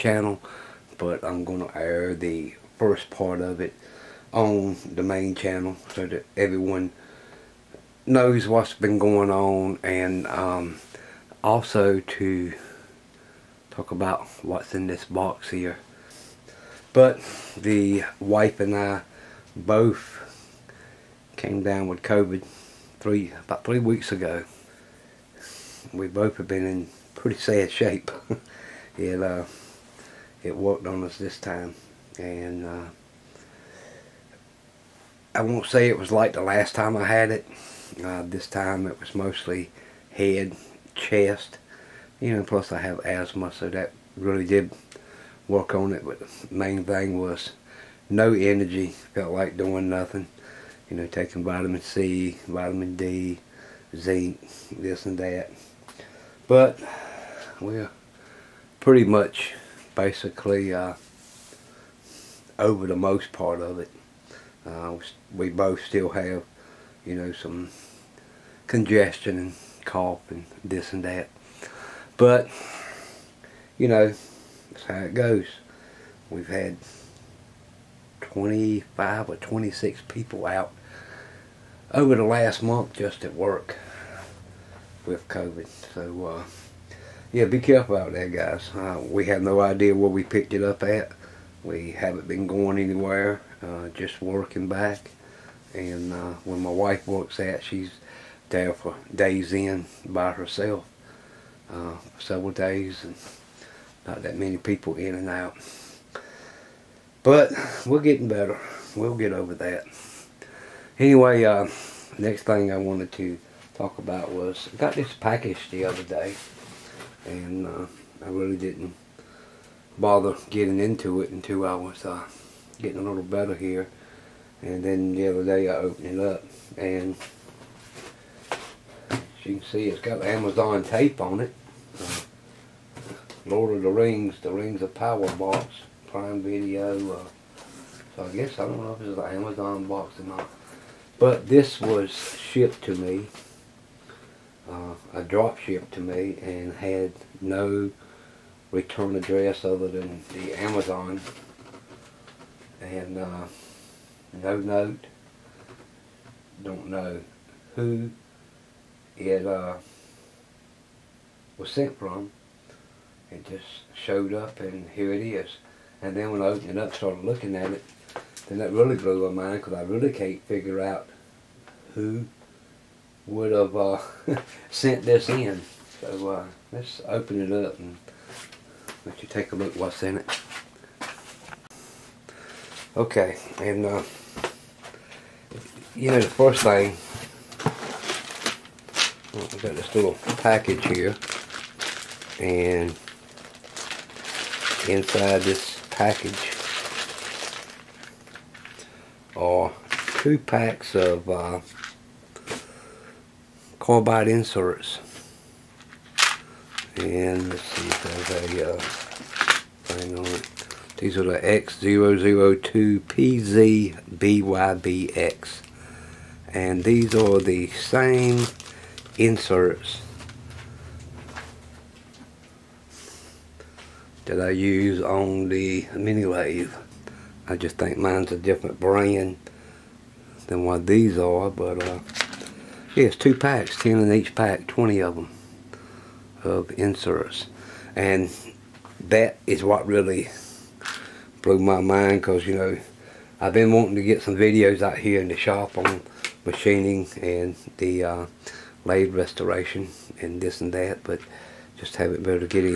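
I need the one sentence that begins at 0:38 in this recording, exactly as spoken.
Uh, this time it was mostly head chest.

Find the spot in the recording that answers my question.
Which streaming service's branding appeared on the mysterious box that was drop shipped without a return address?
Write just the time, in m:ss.
2:16.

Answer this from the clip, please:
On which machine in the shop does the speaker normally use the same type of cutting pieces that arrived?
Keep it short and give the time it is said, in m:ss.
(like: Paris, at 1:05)
mini lathe, at 3:45.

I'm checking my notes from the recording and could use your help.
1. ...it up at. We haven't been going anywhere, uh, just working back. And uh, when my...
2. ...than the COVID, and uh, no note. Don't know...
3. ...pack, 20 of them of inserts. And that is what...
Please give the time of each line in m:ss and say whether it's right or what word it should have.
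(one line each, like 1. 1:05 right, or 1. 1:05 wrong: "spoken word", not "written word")
1. 1:30 right
2. 2:29 wrong: "Amazon", not "COVID"
3. 3:54 right.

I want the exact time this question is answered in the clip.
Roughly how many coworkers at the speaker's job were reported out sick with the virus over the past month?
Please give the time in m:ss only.
1:18.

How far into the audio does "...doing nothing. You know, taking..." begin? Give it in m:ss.
0:49.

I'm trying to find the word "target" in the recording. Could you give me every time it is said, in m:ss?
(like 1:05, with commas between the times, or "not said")
not said.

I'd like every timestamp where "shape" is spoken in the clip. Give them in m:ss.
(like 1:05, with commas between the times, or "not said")
0:27.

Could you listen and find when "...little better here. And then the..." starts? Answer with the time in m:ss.
2:03.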